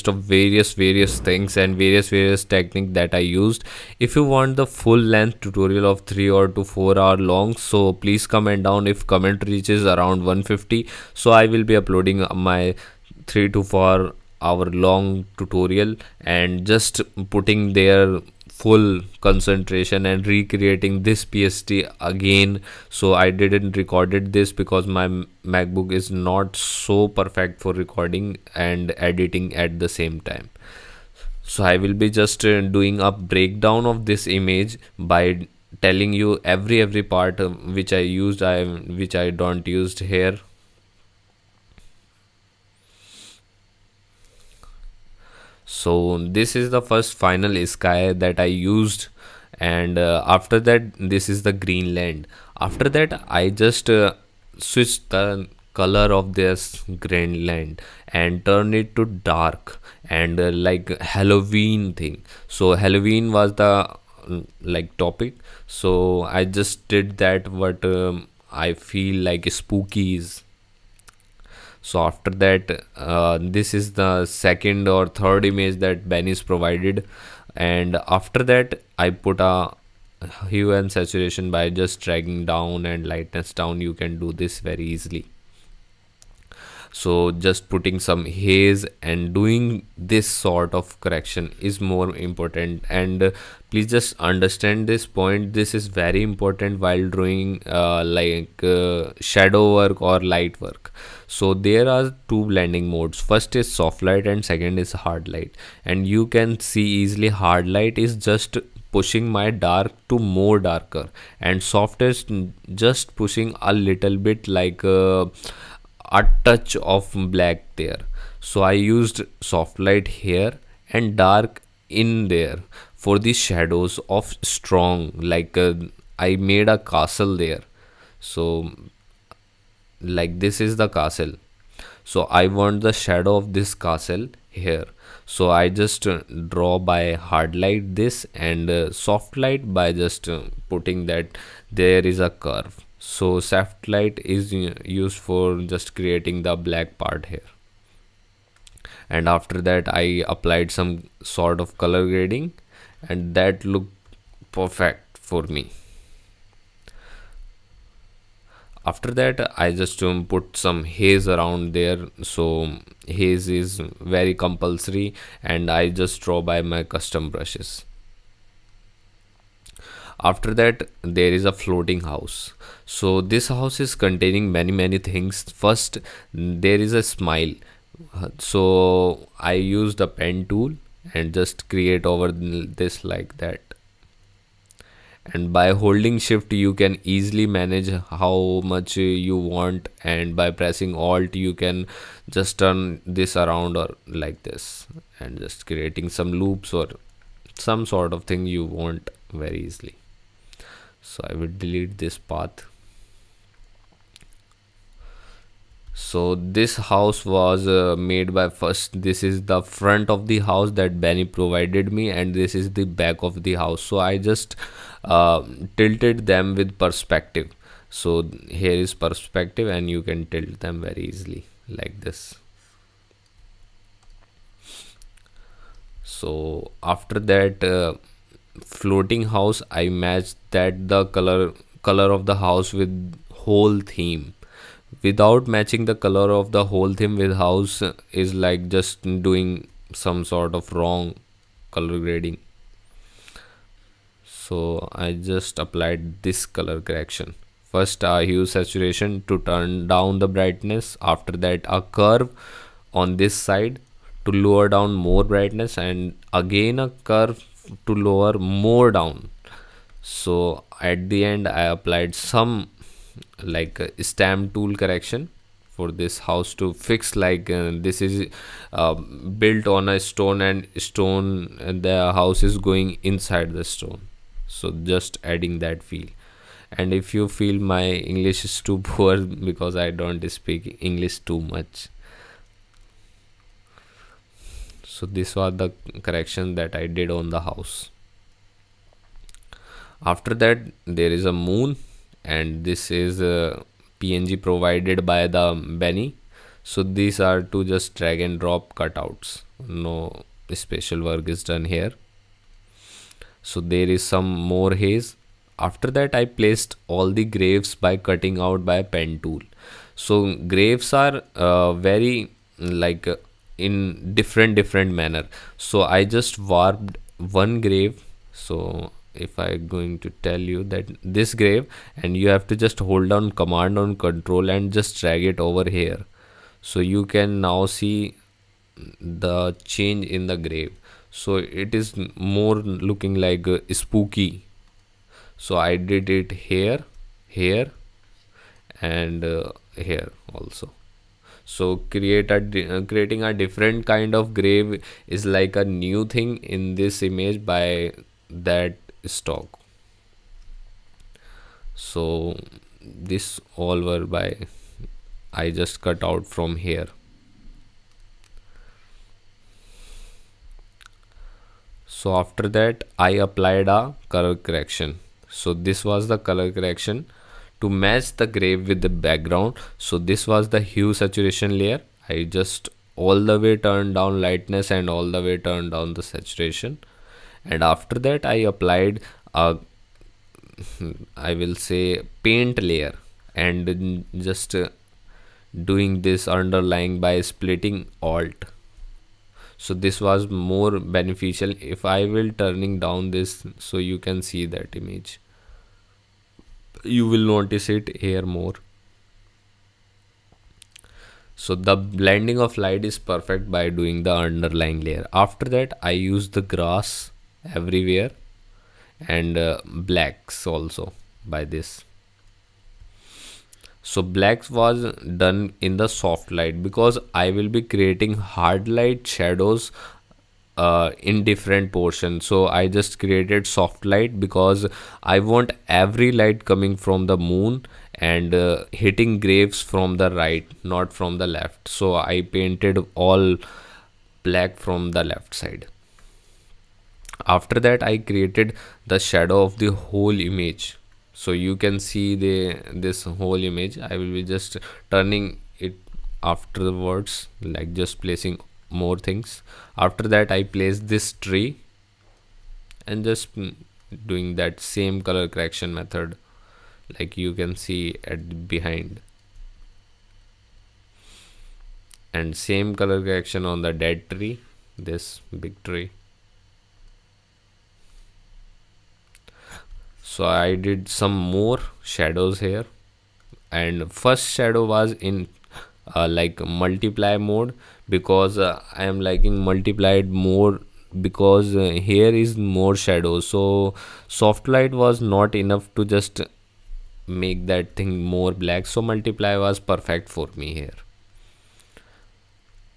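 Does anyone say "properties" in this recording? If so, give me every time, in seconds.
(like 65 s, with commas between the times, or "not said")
not said.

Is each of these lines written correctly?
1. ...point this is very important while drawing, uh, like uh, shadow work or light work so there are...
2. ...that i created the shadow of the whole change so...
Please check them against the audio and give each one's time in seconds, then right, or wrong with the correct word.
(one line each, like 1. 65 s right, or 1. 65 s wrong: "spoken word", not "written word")
1. 95 s right
2. 437 s wrong: "image", not "change".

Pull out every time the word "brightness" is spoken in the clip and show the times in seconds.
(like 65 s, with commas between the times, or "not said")
250 s, 255 s.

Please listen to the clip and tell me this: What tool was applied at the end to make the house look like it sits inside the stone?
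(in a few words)
stamp tool.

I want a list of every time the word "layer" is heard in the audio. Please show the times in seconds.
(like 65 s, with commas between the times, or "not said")
371 s, 382 s, 404 s.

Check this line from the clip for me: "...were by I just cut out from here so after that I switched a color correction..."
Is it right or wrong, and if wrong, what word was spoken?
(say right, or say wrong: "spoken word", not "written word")
wrong: "applied", not "switched".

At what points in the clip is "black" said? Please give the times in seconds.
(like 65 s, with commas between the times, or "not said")
117 s, 146 s, 409 s, 414 s, 434 s, 488 s.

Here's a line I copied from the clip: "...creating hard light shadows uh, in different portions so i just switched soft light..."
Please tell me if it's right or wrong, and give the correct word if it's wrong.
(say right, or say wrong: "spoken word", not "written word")
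wrong: "created", not "switched".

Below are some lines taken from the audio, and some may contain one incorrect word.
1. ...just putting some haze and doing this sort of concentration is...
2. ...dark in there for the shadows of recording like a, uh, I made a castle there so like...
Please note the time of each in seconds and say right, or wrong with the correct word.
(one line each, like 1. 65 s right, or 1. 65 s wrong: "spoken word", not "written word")
1. 87 s wrong: "correction", not "concentration"
2. 121 s wrong: "strong", not "recording".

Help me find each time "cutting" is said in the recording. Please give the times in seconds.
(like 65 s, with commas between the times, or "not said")
307 s.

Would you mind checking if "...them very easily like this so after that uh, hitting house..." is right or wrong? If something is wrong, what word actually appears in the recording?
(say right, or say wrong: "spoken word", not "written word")
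wrong: "floating", not "hitting".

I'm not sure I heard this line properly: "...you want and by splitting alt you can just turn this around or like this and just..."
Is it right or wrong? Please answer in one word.
wrong.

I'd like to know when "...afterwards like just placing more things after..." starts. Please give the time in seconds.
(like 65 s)
446 s.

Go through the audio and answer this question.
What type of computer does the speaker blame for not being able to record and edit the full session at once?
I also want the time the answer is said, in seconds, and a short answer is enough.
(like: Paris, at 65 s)
MacBook, at 25 s.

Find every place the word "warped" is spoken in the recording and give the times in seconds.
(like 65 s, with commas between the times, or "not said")
316 s.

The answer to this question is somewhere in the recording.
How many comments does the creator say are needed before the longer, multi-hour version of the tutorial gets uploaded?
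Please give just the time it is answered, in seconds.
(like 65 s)
10 s.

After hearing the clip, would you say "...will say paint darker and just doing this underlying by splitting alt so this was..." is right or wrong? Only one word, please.
wrong.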